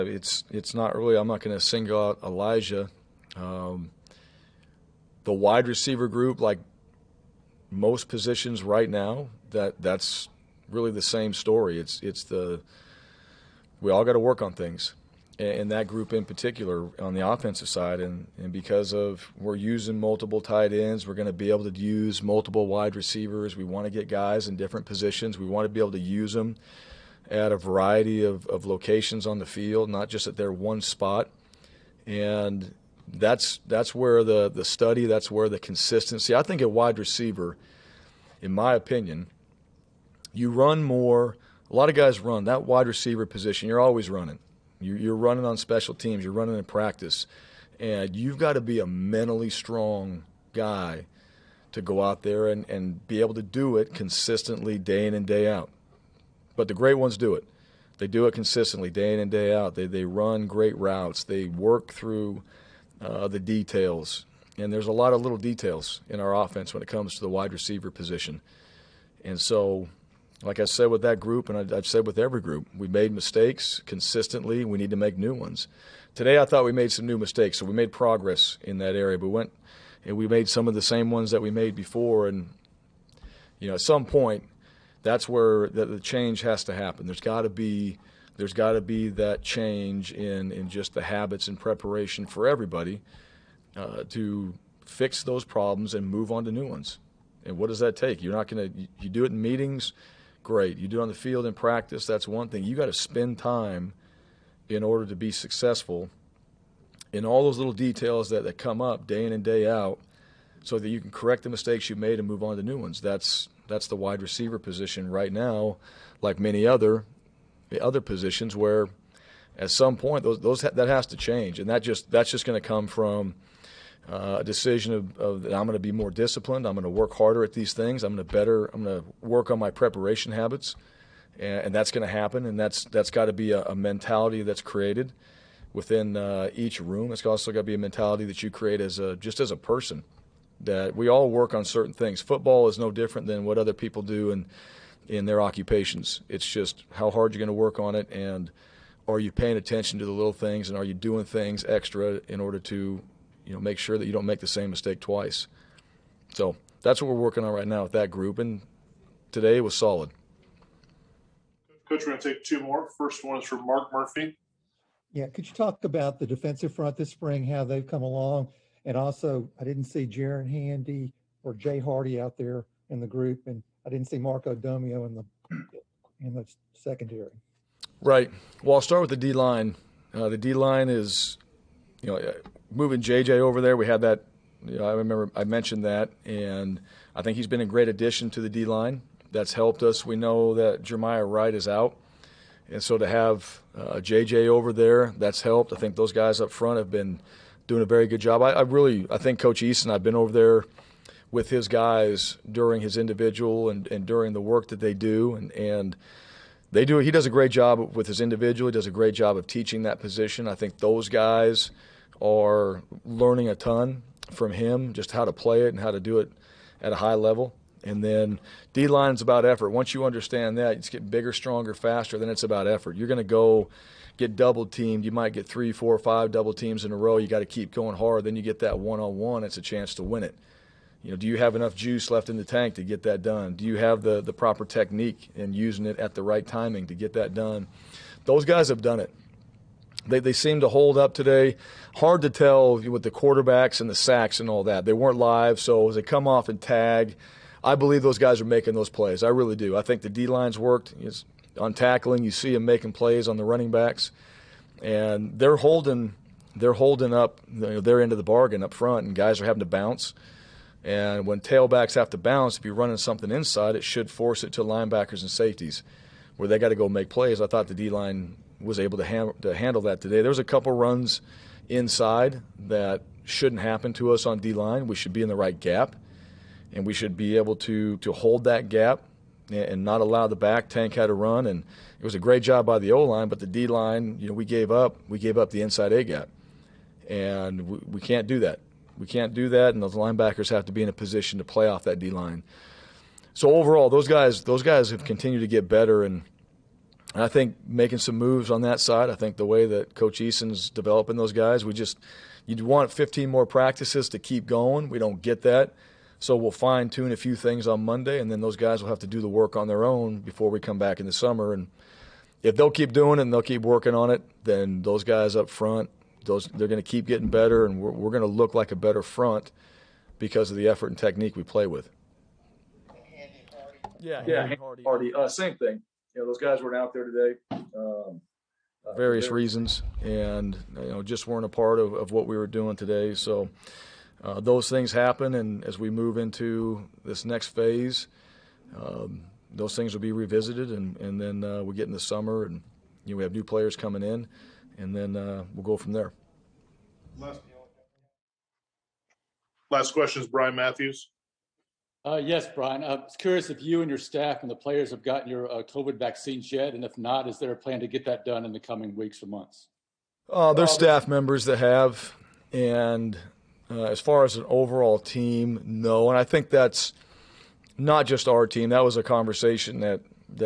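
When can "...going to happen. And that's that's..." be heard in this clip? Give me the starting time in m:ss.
2:11.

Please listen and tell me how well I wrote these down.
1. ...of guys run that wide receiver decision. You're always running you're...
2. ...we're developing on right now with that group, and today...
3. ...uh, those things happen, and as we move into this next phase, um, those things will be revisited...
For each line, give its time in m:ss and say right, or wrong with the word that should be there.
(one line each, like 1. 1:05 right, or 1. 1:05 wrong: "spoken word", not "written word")
1. 0:41 wrong: "position", not "decision"
2. 2:37 wrong: "working", not "developing"
3. 5:34 right.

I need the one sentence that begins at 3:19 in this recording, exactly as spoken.
I've been over there with his guys during his individual and, and during the work that they do, and and they do.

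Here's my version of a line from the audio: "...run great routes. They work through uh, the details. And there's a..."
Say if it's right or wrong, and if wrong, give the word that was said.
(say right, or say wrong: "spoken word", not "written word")
right.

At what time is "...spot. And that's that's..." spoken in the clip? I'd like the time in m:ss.
0:30.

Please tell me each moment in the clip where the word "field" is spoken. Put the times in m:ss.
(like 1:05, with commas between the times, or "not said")
0:29, 1:41.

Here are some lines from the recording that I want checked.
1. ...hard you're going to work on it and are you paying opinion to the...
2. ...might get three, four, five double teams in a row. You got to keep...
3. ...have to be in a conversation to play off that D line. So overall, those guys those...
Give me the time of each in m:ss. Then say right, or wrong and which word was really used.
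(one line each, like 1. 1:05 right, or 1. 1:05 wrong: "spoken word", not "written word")
1. 2:27 wrong: "attention", not "opinion"
2. 3:45 right
3. 4:50 wrong: "position", not "conversation".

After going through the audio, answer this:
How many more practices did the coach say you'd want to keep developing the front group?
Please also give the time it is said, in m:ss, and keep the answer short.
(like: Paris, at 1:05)
15, at 5:02.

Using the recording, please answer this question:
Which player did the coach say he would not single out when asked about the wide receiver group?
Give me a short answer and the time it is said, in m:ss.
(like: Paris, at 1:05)
Elijah, at 0:02.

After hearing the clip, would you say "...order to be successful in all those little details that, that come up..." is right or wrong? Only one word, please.
right.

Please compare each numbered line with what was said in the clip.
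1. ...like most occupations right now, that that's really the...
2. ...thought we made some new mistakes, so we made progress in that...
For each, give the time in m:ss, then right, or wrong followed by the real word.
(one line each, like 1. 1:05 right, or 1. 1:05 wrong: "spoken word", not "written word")
1. 0:06 wrong: "positions", not "occupations"
2. 1:16 right.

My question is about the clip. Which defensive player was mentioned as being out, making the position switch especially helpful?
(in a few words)
Jeremiah Wright.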